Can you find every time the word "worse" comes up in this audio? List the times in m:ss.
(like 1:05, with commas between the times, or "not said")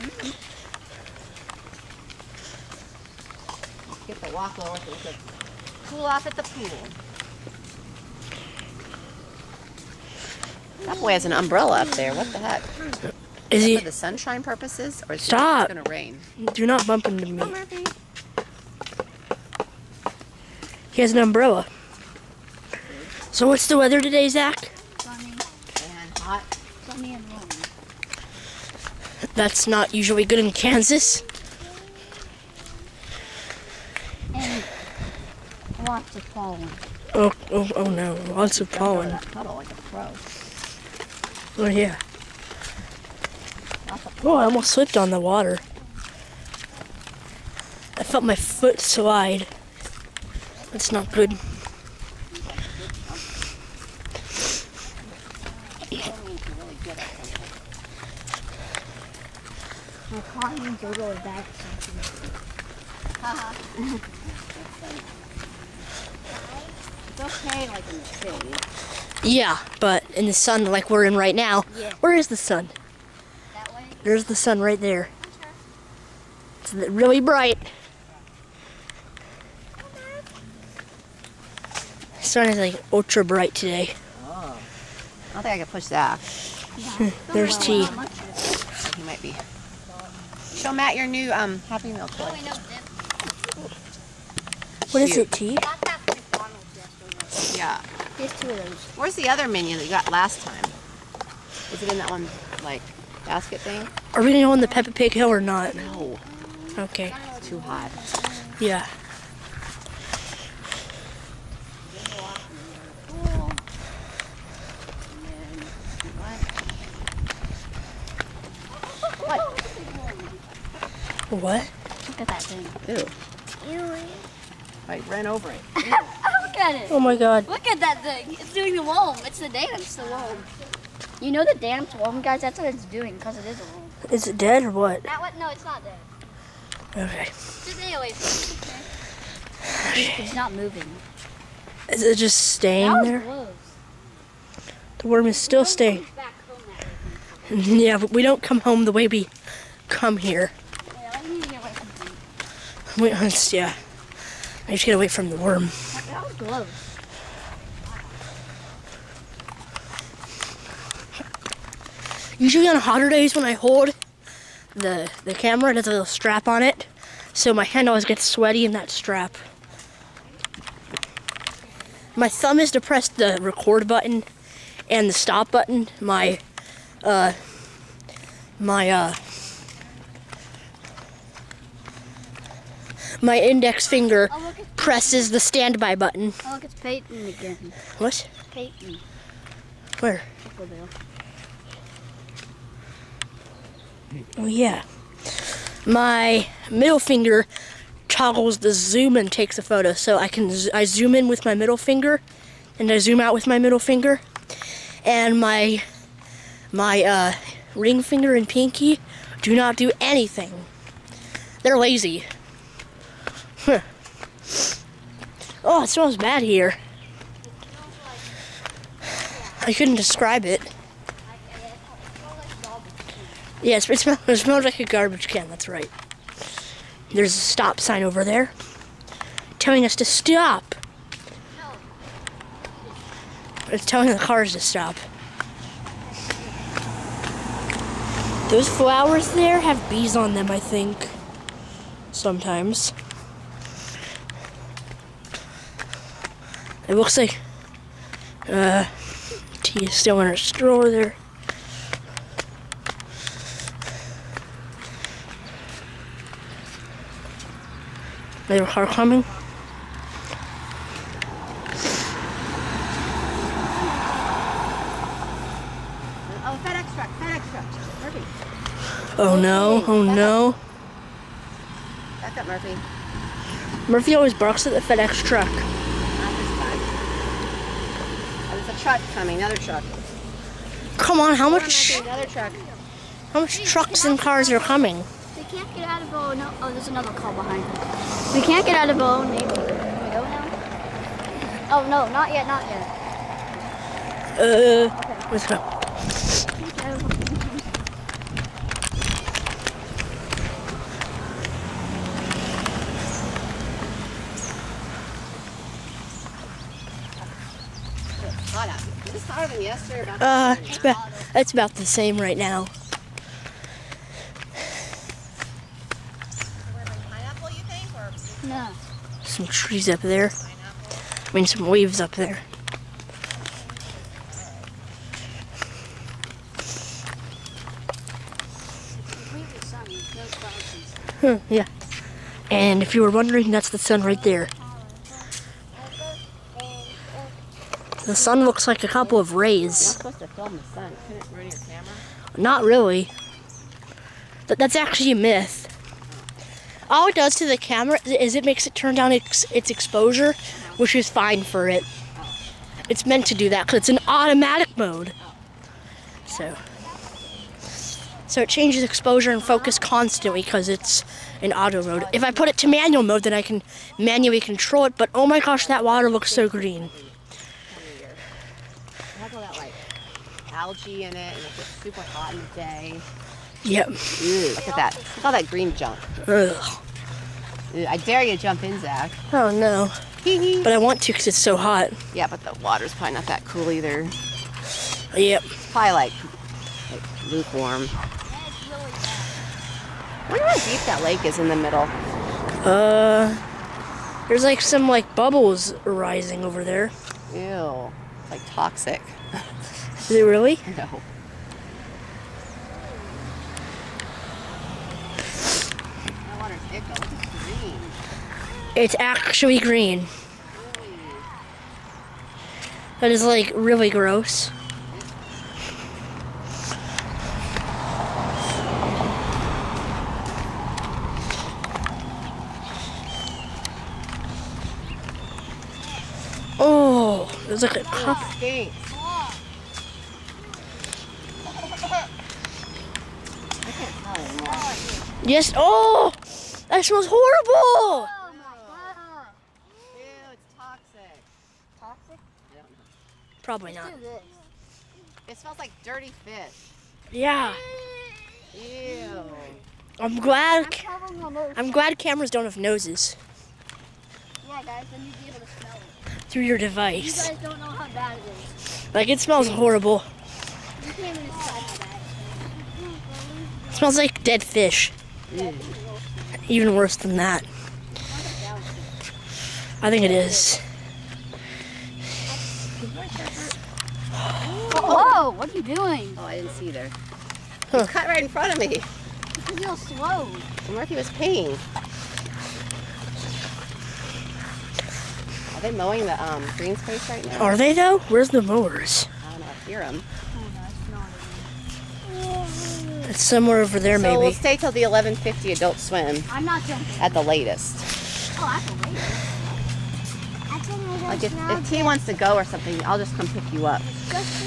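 7:46.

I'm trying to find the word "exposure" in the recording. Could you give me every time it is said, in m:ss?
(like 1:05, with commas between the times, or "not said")
5:49, 5:58.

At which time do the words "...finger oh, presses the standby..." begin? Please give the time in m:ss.
3:03.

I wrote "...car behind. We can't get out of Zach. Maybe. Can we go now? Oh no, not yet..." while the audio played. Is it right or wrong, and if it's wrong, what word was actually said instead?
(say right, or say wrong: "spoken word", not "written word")
wrong: "Bow", not "Zach".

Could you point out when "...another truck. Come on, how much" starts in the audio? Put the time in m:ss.
4:39.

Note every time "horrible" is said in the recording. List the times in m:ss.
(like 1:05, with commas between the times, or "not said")
7:17, 7:39.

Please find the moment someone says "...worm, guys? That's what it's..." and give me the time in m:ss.
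2:11.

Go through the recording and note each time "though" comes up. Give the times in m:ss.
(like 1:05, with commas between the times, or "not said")
8:07.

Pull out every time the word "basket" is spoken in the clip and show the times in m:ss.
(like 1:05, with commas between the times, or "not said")
1:43.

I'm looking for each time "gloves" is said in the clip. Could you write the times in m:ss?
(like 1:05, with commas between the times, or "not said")
2:36.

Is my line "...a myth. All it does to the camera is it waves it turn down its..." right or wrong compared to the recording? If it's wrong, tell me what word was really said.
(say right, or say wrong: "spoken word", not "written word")
wrong: "makes", not "waves".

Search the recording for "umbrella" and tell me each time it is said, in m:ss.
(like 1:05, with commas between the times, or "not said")
0:11, 0:21.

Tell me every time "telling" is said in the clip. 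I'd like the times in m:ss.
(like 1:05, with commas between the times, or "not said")
3:49, 3:53.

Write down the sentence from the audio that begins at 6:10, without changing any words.
algae in it and it gets super hot in the day.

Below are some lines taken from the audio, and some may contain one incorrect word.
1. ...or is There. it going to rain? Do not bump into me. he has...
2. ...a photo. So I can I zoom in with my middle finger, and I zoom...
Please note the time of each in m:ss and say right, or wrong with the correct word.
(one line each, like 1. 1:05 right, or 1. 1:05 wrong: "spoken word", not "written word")
1. 0:15 wrong: "Stop", not "There"
2. 3:19 right.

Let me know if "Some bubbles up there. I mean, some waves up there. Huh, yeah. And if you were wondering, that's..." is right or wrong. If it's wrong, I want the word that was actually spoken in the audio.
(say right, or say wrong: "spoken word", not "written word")
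wrong: "trees", not "bubbles".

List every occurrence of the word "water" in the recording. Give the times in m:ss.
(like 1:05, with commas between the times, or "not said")
0:45, 6:05, 6:22.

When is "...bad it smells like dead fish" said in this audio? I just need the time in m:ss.
7:41.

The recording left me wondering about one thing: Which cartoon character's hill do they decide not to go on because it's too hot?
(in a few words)
Peppa Pig.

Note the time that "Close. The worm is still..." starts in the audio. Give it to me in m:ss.
2:23.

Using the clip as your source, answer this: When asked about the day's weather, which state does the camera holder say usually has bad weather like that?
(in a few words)
Kansas.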